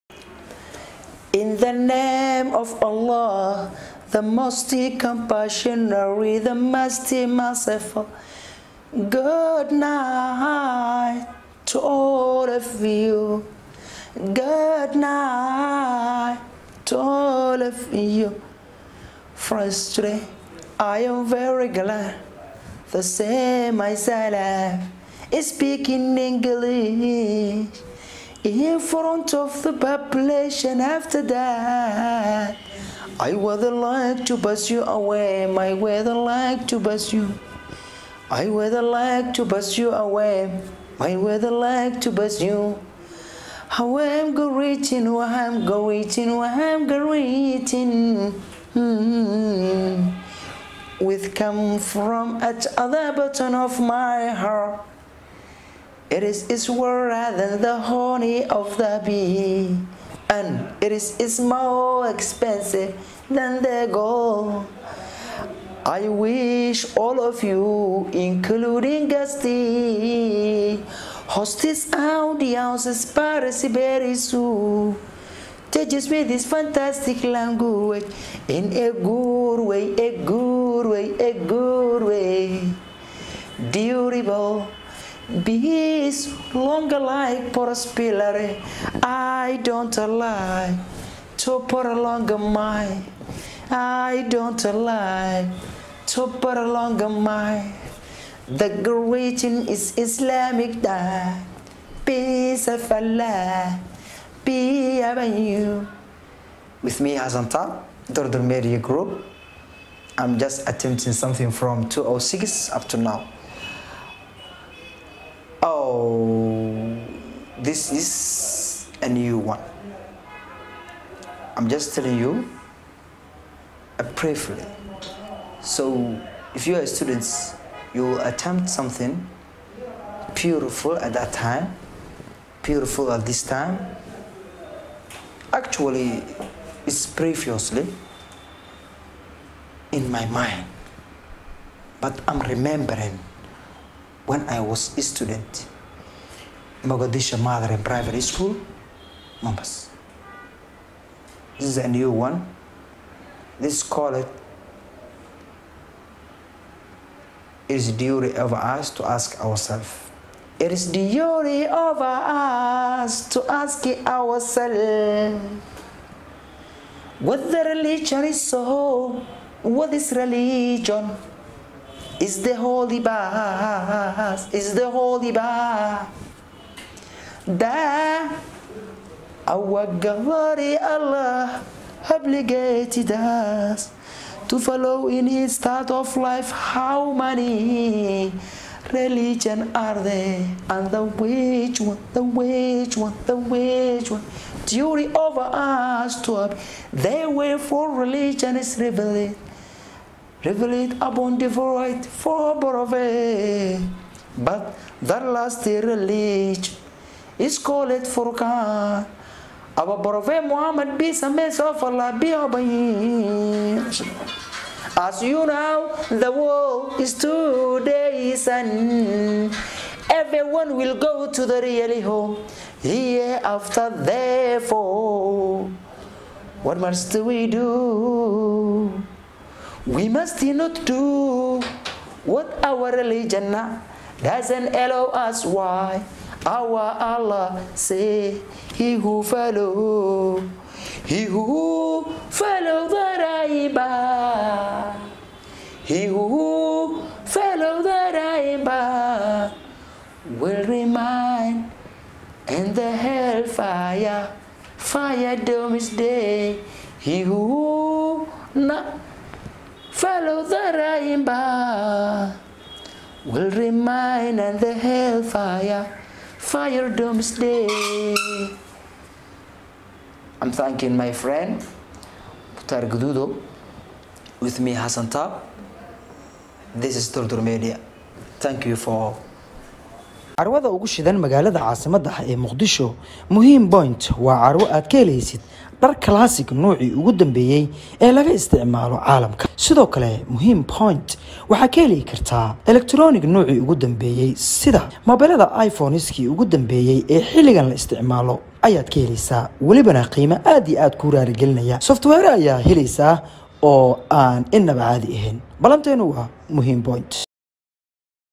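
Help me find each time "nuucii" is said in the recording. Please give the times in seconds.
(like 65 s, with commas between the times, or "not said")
286 s, 293 s.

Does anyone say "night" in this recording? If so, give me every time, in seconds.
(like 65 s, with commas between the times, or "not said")
9 s, 14 s.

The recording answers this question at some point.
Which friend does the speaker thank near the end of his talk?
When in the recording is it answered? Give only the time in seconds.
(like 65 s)
272 s.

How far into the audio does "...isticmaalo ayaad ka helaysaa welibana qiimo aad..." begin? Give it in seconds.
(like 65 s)
297 s.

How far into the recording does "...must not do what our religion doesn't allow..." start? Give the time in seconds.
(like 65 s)
230 s.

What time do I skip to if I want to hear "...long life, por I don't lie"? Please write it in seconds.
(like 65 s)
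86 s.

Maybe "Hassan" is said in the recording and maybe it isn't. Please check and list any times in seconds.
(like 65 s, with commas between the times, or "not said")
107 s, 274 s.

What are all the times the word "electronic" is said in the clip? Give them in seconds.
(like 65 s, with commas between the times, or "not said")
292 s.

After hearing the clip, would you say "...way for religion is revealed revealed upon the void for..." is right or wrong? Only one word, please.
right.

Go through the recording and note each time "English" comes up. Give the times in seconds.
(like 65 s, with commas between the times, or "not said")
26 s.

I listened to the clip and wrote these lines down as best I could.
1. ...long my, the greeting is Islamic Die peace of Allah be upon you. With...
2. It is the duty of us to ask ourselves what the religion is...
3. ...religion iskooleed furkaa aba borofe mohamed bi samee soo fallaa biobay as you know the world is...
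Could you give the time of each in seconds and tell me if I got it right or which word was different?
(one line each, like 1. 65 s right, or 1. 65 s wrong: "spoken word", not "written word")
1. 96 s right
2. 160 s right
3. 205 s right.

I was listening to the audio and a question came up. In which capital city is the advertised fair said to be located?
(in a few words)
Mogadishu.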